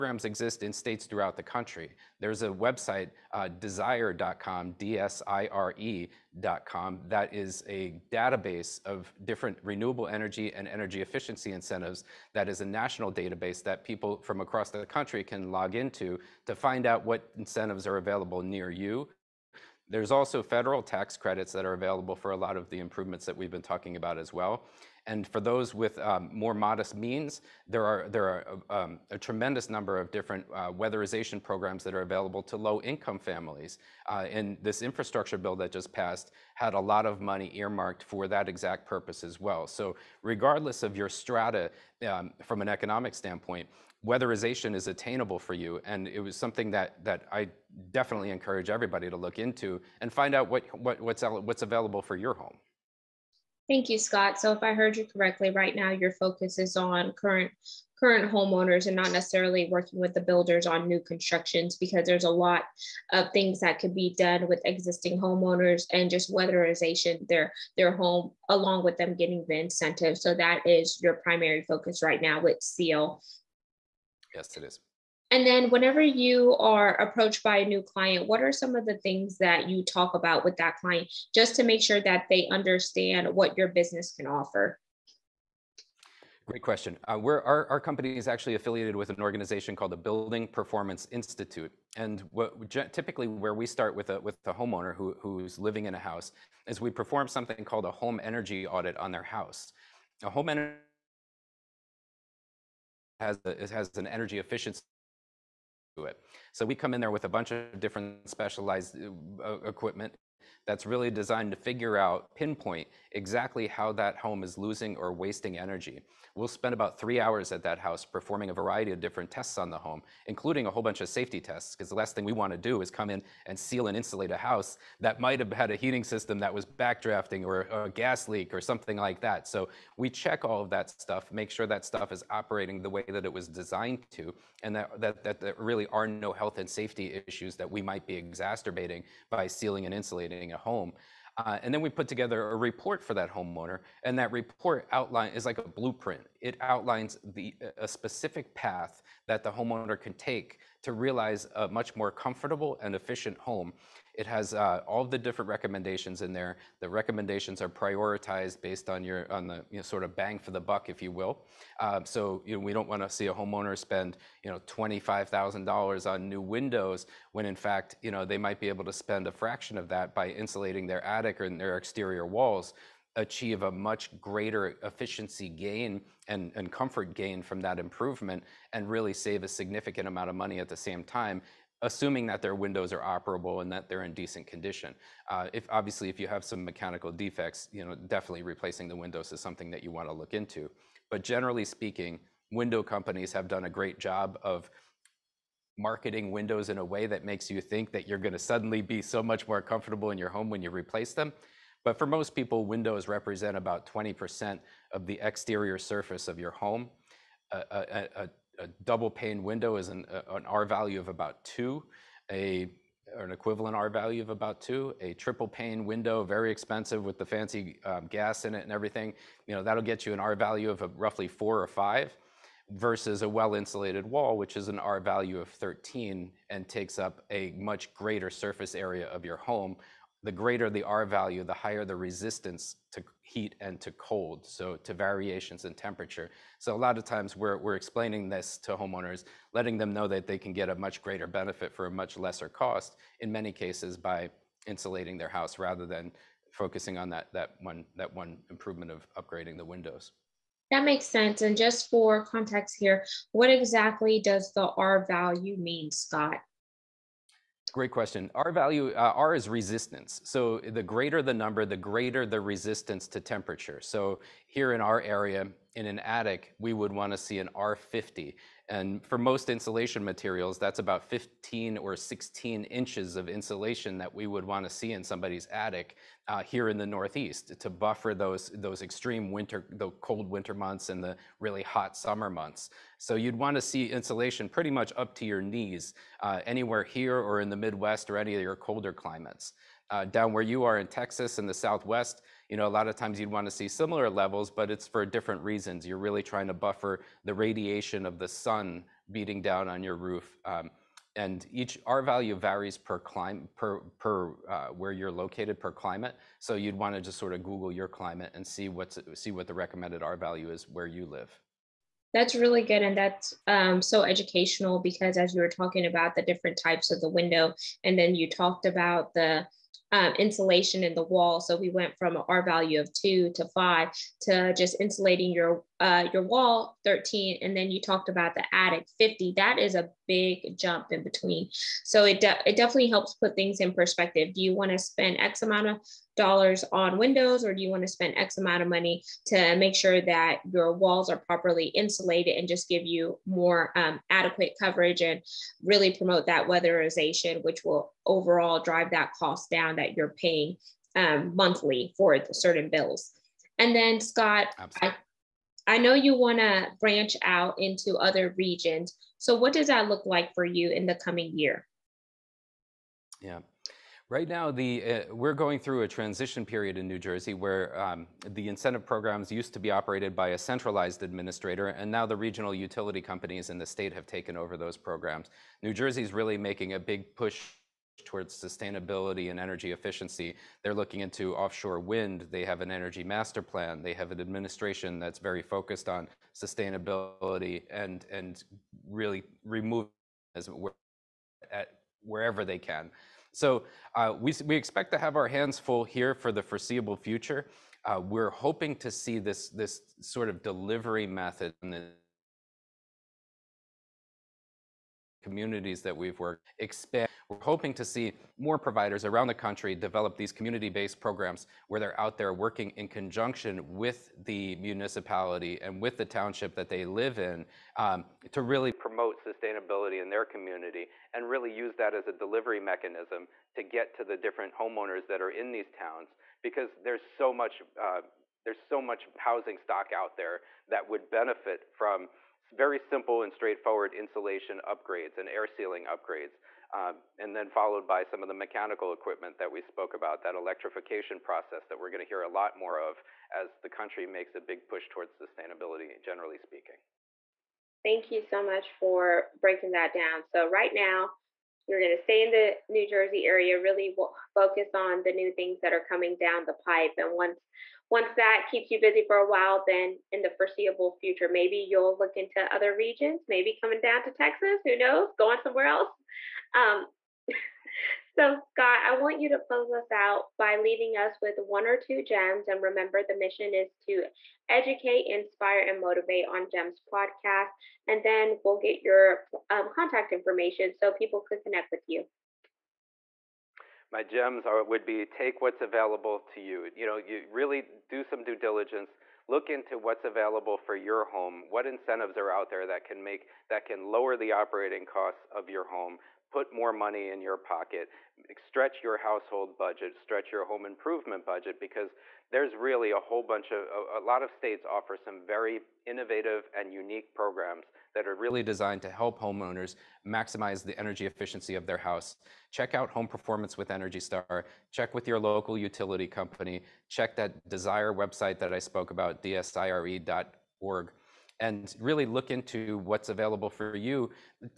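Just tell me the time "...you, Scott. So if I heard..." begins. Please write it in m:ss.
0:53.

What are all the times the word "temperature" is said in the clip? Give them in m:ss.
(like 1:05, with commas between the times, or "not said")
3:55, 4:23.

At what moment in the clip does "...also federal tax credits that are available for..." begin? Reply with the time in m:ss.
0:20.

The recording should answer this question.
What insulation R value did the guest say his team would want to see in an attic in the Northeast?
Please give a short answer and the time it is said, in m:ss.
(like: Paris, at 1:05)
R50, at 4:27.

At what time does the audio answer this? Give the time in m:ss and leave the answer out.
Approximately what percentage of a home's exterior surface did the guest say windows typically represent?
3:23.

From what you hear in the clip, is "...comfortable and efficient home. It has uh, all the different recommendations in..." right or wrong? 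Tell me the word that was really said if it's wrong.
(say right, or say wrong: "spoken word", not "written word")
right.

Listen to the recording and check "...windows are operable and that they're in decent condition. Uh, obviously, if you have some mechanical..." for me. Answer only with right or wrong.
right.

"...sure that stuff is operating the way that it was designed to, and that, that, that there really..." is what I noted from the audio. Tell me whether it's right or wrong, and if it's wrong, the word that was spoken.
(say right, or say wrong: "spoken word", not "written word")
right.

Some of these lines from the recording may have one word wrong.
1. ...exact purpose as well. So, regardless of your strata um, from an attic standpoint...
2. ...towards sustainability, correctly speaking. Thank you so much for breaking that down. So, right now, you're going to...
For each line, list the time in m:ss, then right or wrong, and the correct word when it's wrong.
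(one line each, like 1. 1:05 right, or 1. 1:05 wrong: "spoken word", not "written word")
1. 0:38 wrong: "economic", not "attic"
2. 7:24 wrong: "generally", not "correctly".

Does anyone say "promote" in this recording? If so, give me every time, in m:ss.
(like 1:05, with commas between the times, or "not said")
5:45, 6:58.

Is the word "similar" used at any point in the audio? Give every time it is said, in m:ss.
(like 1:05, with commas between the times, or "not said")
4:53.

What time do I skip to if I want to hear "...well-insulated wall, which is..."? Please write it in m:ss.
3:43.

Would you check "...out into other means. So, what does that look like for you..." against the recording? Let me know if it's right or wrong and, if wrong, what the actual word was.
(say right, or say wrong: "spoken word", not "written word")
wrong: "regions", not "means".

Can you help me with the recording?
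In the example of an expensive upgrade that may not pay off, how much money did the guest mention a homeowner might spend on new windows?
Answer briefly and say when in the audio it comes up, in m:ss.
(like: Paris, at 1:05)
$25,000, at 2:44.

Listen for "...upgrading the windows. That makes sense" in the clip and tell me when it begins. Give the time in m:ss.
4:09.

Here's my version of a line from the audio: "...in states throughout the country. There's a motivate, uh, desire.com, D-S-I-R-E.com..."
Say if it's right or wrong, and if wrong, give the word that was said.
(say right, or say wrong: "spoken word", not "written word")
wrong: "website", not "motivate".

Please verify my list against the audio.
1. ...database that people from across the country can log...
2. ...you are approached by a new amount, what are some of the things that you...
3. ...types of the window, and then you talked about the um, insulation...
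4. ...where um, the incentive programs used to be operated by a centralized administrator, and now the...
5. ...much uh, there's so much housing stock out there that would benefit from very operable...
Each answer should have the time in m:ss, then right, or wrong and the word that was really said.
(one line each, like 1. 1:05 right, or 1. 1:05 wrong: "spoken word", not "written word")
1. 0:13 right
2. 1:16 wrong: "client", not "amount"
3. 5:16 right
4. 6:07 right
5. 7:07 wrong: "simple", not "operable".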